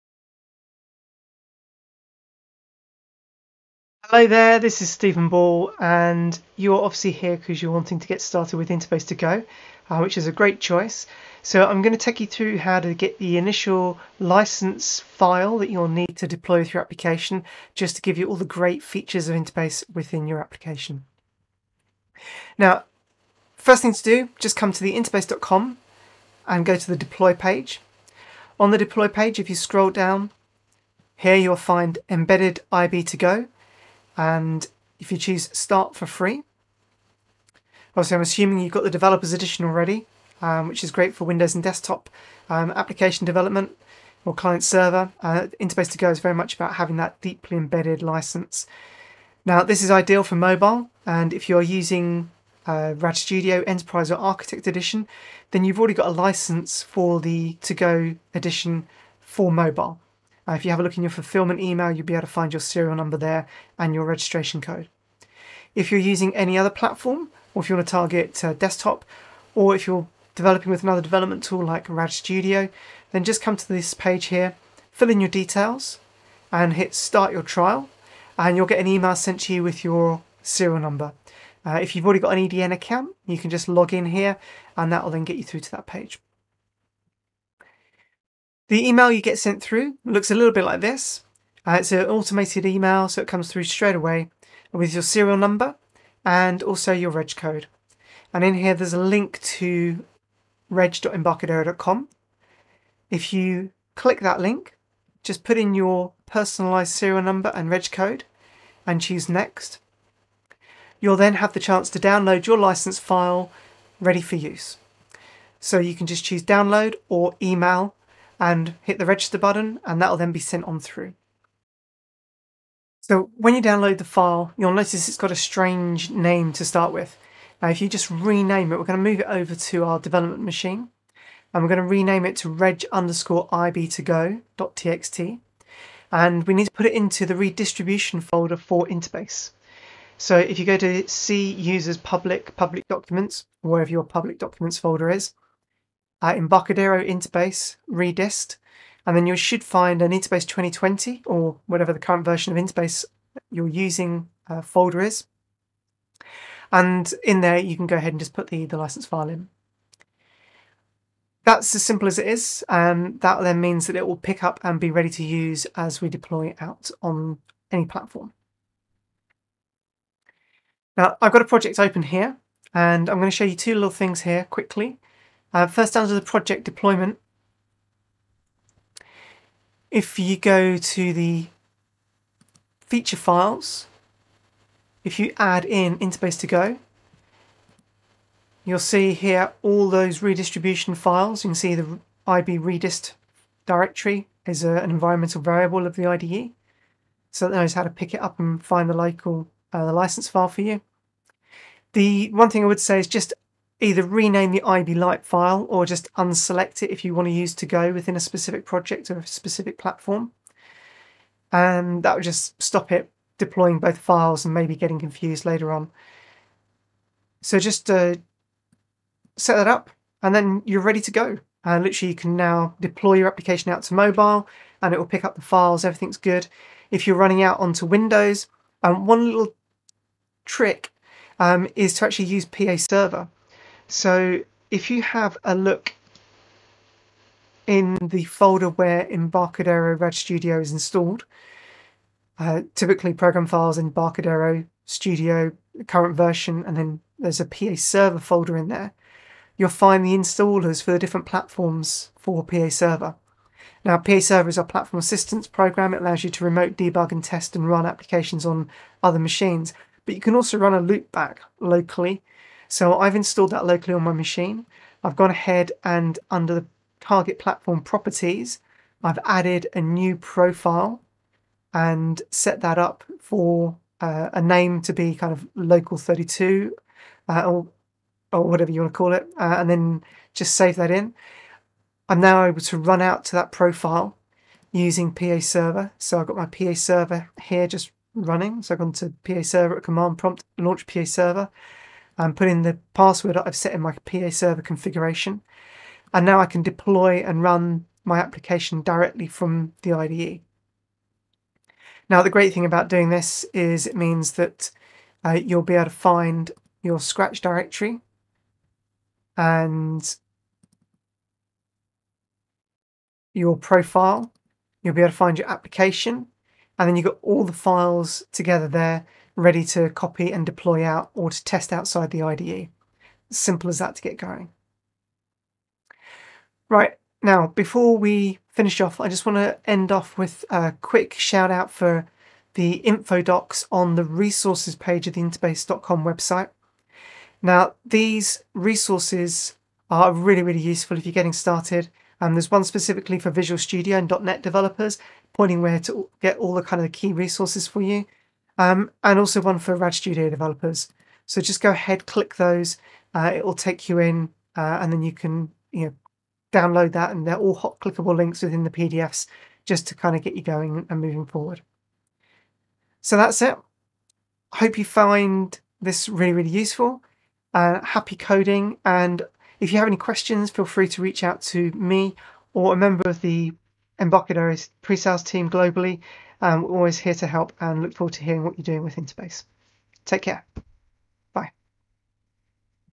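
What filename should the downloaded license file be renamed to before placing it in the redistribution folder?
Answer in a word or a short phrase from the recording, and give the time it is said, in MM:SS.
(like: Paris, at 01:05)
reg_ib2go.txt, at 02:12.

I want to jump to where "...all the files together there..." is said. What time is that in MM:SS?
05:17.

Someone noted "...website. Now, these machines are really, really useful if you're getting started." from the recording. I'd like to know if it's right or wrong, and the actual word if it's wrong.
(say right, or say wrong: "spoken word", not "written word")
wrong: "resources", not "machines".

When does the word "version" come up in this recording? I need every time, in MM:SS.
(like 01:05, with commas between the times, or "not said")
02:32, 04:06.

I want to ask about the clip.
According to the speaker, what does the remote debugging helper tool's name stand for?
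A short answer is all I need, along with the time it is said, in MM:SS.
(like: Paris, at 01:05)
platform assistance, at 04:14.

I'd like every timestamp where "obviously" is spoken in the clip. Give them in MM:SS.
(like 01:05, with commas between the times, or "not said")
00:06, 00:37.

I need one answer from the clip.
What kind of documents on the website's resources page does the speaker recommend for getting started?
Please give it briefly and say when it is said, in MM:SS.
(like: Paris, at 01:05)
info docs, at 05:32.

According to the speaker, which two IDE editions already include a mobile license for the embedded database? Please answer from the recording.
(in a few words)
Enterprise or Architect.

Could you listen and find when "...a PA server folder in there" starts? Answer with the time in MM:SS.
04:07.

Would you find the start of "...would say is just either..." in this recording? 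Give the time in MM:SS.
03:22.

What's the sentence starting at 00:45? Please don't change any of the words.
Uh, Interbase to Go is very much about having that deeply embedded license.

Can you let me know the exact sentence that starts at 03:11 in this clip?
You can see the IB redist directory is a, an environmental variable of the IDE.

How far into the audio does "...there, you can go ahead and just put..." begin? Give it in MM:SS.
02:37.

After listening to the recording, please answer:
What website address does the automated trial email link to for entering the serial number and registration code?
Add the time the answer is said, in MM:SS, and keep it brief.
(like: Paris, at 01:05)
reg.embarcadero.com, at 01:40.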